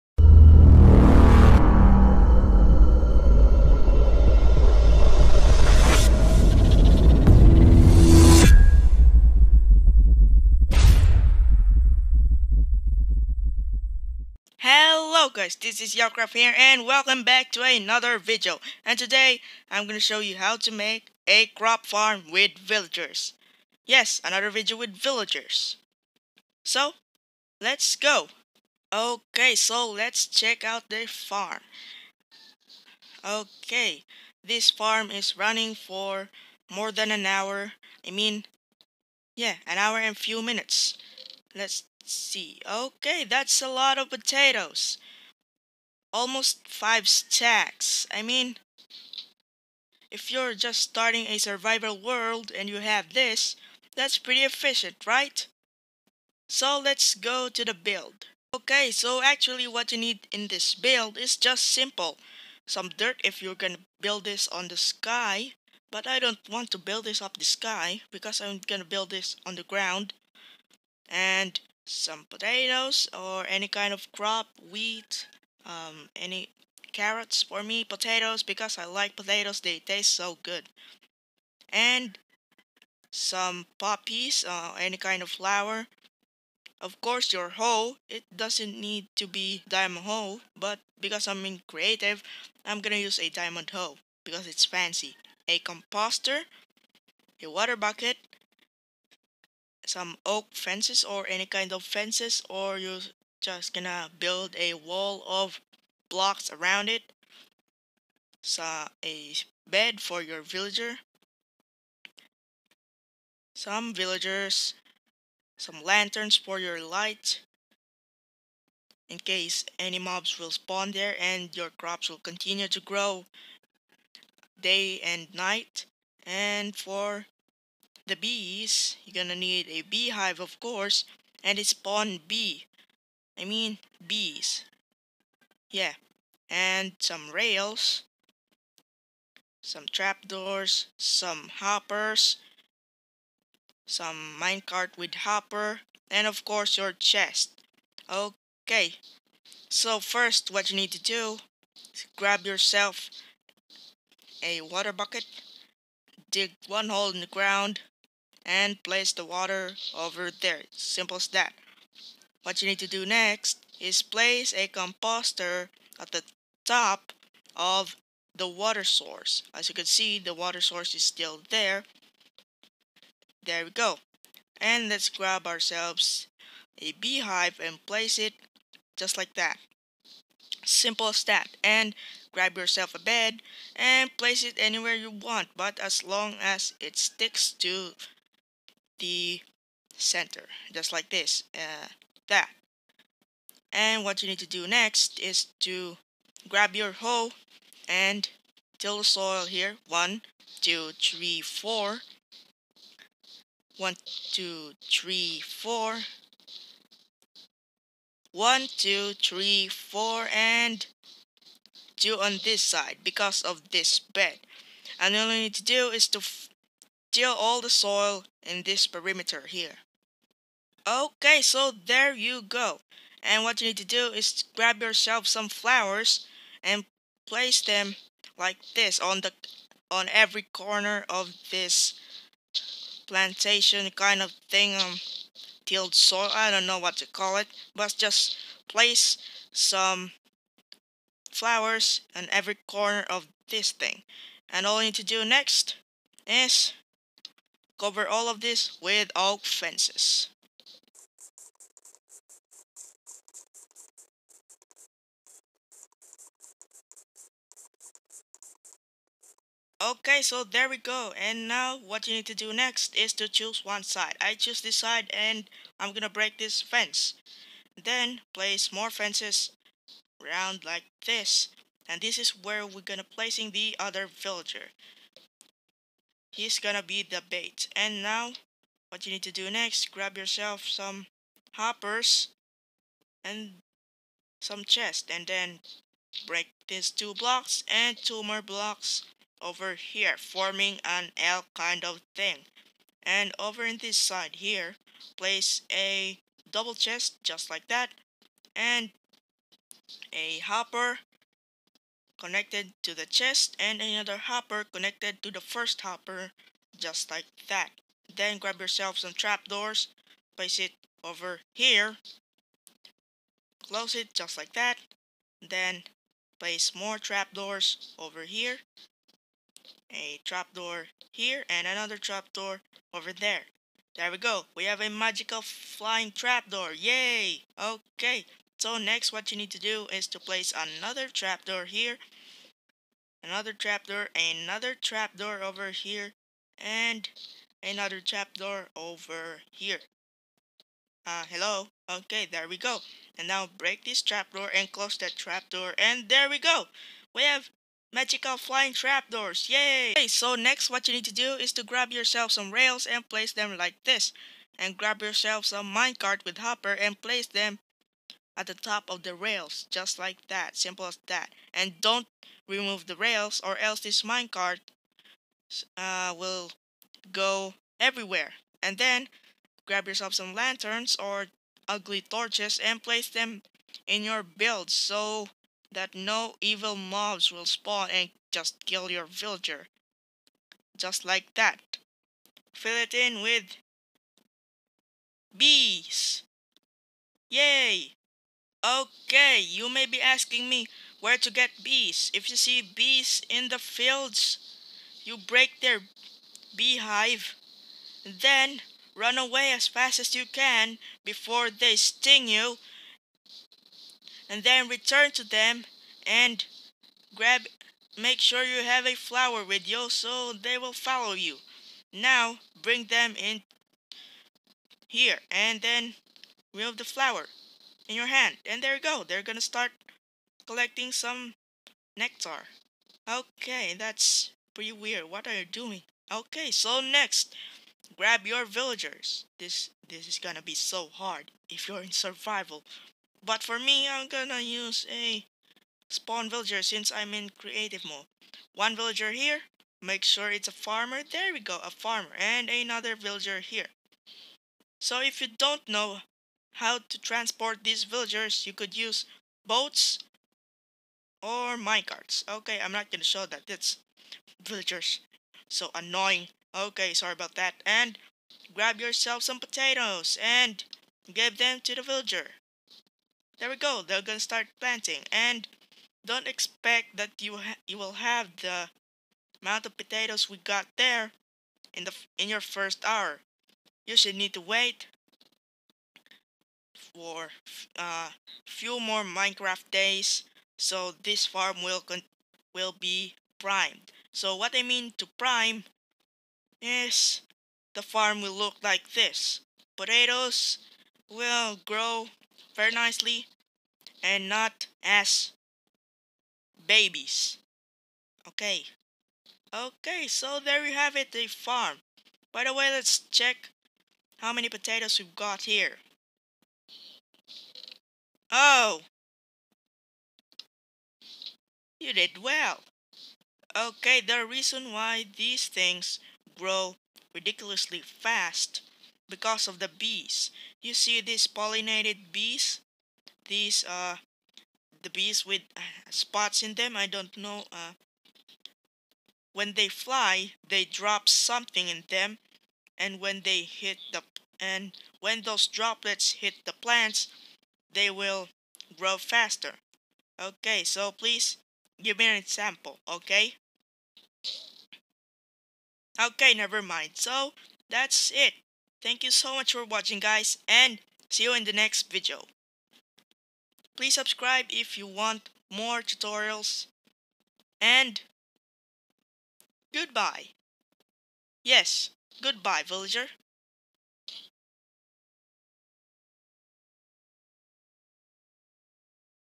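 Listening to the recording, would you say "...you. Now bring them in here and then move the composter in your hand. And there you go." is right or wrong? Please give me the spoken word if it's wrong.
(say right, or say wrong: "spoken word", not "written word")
wrong: "flower", not "composter".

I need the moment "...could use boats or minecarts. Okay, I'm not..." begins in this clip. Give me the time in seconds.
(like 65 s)
448 s.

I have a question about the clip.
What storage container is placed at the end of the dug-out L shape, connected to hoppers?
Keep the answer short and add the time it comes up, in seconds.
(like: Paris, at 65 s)
double chest, at 296 s.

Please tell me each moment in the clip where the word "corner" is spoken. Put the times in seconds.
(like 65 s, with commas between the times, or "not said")
230 s, 242 s.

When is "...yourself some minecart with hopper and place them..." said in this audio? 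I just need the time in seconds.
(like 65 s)
355 s.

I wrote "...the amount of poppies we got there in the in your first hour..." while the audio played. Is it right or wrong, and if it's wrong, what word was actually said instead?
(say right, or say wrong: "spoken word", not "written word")
wrong: "potatoes", not "poppies".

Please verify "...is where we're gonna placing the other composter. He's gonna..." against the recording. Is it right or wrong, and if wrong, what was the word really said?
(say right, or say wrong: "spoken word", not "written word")
wrong: "villager", not "composter".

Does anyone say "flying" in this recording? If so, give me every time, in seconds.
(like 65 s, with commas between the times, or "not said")
325 s, 348 s.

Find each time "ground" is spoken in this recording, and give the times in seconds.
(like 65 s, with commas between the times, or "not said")
69 s, 157 s.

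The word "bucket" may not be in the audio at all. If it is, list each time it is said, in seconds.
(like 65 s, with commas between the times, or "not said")
97 s, 154 s.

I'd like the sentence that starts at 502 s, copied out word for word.
By the way, let's check how many potatoes we've got here.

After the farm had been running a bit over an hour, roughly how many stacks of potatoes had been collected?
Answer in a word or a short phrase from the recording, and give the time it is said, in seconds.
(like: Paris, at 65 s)
almost 5 stacks, at 46 s.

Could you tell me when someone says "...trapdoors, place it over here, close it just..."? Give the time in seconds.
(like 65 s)
309 s.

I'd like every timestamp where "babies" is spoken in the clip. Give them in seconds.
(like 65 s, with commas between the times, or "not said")
496 s.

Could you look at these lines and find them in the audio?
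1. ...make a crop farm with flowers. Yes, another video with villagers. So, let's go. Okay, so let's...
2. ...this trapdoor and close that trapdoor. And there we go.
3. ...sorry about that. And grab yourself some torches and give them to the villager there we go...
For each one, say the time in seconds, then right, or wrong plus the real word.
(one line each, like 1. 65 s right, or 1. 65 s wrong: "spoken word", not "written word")
1. 20 s wrong: "villagers", not "flowers"
2. 343 s right
3. 456 s wrong: "potatoes", not "torches".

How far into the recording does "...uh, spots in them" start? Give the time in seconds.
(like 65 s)
525 s.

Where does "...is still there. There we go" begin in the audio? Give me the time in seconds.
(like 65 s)
170 s.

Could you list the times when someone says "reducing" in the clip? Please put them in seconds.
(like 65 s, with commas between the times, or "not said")
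not said.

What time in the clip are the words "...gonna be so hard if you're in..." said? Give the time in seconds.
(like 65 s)
430 s.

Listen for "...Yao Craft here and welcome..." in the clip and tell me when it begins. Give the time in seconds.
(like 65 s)
15 s.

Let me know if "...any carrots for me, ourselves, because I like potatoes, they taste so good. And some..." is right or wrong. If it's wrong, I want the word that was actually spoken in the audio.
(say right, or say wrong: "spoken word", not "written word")
wrong: "potatoes", not "ourselves".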